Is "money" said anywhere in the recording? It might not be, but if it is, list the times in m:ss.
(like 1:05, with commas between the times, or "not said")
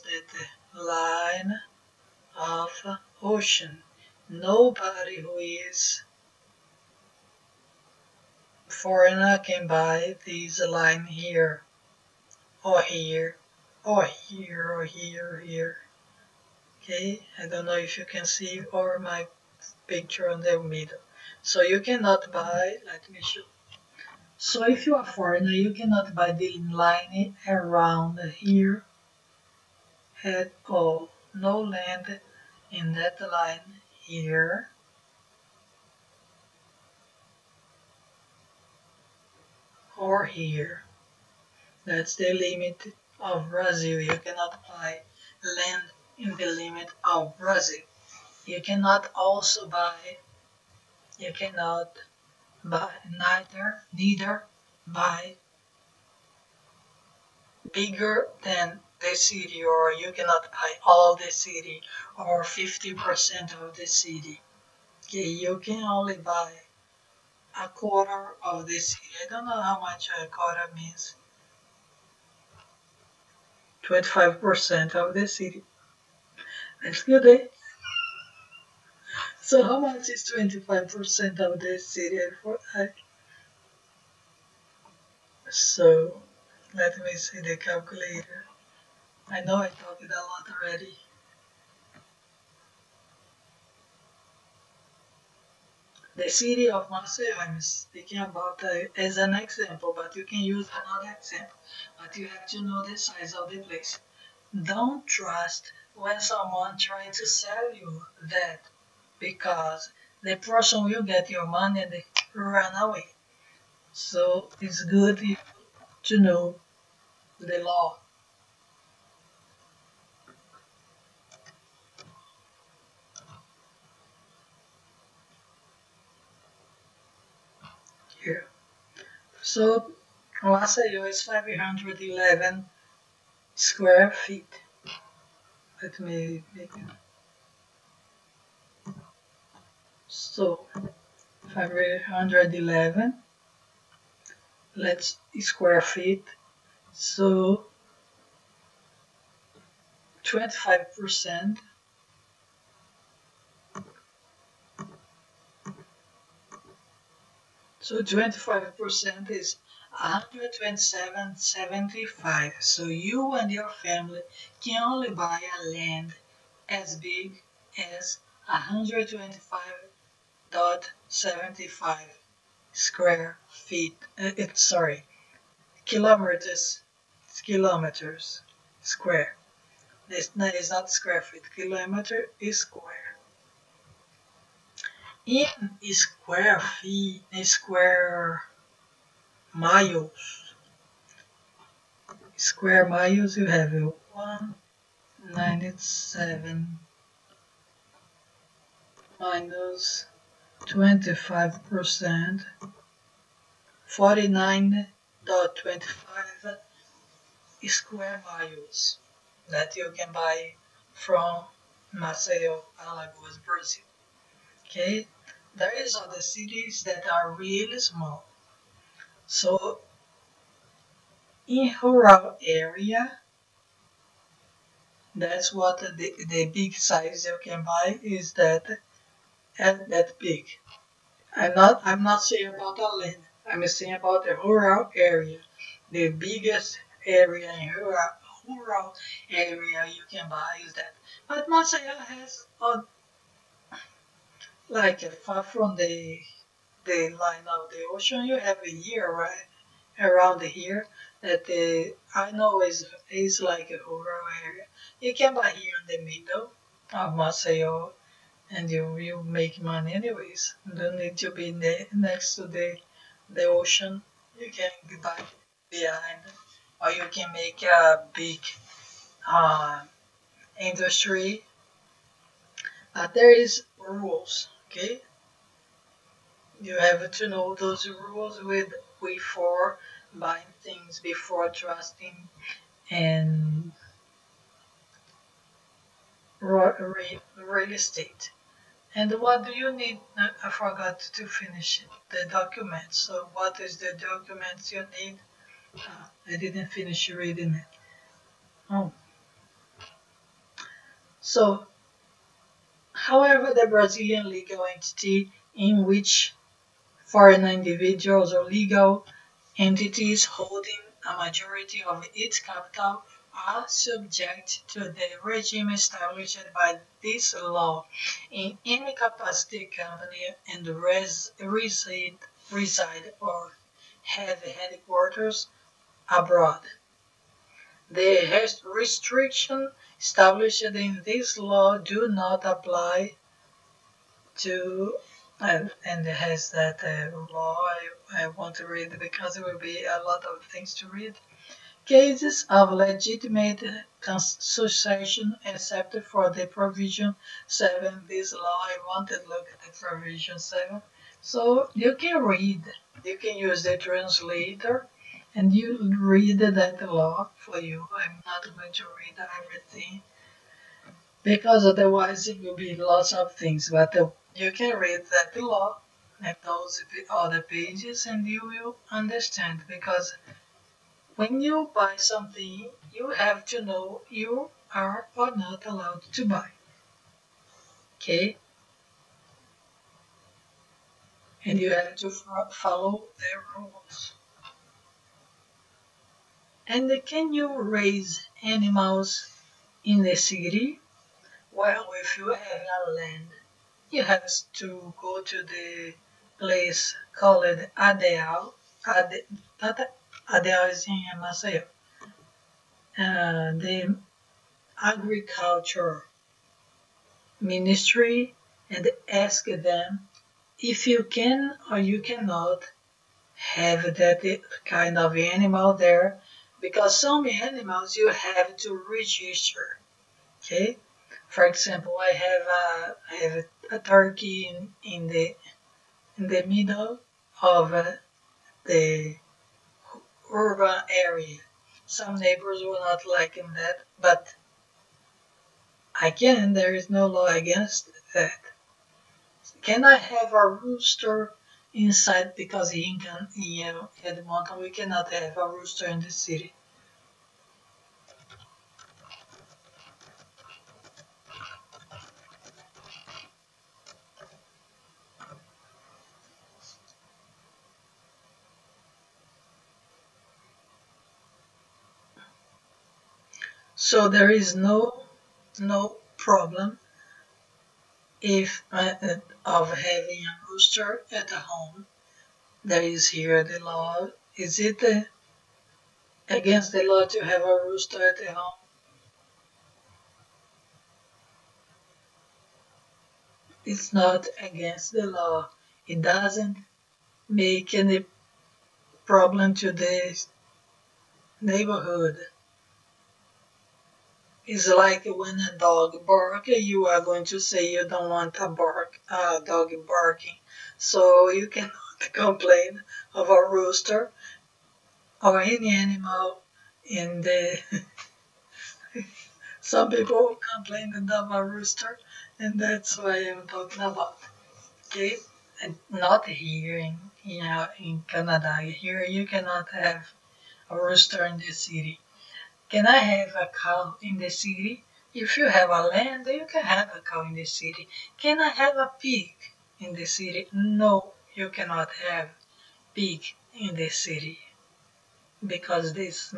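1:51, 4:19.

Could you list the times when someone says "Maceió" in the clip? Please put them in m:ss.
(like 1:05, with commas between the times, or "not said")
1:36, 3:31, 4:01, 4:17, 6:41.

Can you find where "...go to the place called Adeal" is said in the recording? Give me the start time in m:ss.
6:34.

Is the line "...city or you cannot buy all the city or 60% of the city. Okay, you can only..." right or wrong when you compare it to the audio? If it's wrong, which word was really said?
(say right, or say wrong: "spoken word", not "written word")
wrong: "50", not "60".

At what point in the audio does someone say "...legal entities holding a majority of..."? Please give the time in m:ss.
5:08.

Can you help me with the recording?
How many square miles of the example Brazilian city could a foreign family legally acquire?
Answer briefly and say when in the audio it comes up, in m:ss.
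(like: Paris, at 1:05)
49.25, at 3:23.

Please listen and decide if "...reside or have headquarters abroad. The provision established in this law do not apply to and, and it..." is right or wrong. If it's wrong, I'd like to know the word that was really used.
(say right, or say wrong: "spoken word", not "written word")
wrong: "restriction", not "provision".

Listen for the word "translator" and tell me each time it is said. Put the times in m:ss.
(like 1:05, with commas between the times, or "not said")
5:53.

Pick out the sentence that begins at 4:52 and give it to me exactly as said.
So what is the document you need?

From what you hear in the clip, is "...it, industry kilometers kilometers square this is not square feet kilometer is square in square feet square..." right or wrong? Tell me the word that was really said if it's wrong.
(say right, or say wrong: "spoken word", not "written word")
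wrong: "sorry", not "industry".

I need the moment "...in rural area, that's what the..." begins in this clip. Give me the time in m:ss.
3:41.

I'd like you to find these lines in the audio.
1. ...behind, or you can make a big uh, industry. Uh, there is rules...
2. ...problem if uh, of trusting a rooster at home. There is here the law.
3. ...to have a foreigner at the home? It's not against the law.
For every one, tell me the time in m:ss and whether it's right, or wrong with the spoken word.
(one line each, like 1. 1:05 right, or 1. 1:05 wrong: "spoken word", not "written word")
1. 4:25 right
2. 7:46 wrong: "having", not "trusting"
3. 7:57 wrong: "rooster", not "foreigner".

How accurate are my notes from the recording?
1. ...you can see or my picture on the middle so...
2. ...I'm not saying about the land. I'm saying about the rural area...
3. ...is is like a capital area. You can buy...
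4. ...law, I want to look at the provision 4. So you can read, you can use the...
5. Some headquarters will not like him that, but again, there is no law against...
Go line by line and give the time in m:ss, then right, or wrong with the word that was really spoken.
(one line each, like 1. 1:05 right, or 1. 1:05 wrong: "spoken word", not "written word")
1. 0:17 right
2. 3:51 right
3. 4:12 wrong: "rural", not "capital"
4. 5:48 wrong: "7", not "4"
5. 7:11 wrong: "neighbors", not "headquarters".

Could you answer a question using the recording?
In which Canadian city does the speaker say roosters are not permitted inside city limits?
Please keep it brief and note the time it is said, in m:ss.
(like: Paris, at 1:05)
Edmonton, at 7:24.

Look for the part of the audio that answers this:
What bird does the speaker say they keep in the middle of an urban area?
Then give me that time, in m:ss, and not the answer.
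7:03.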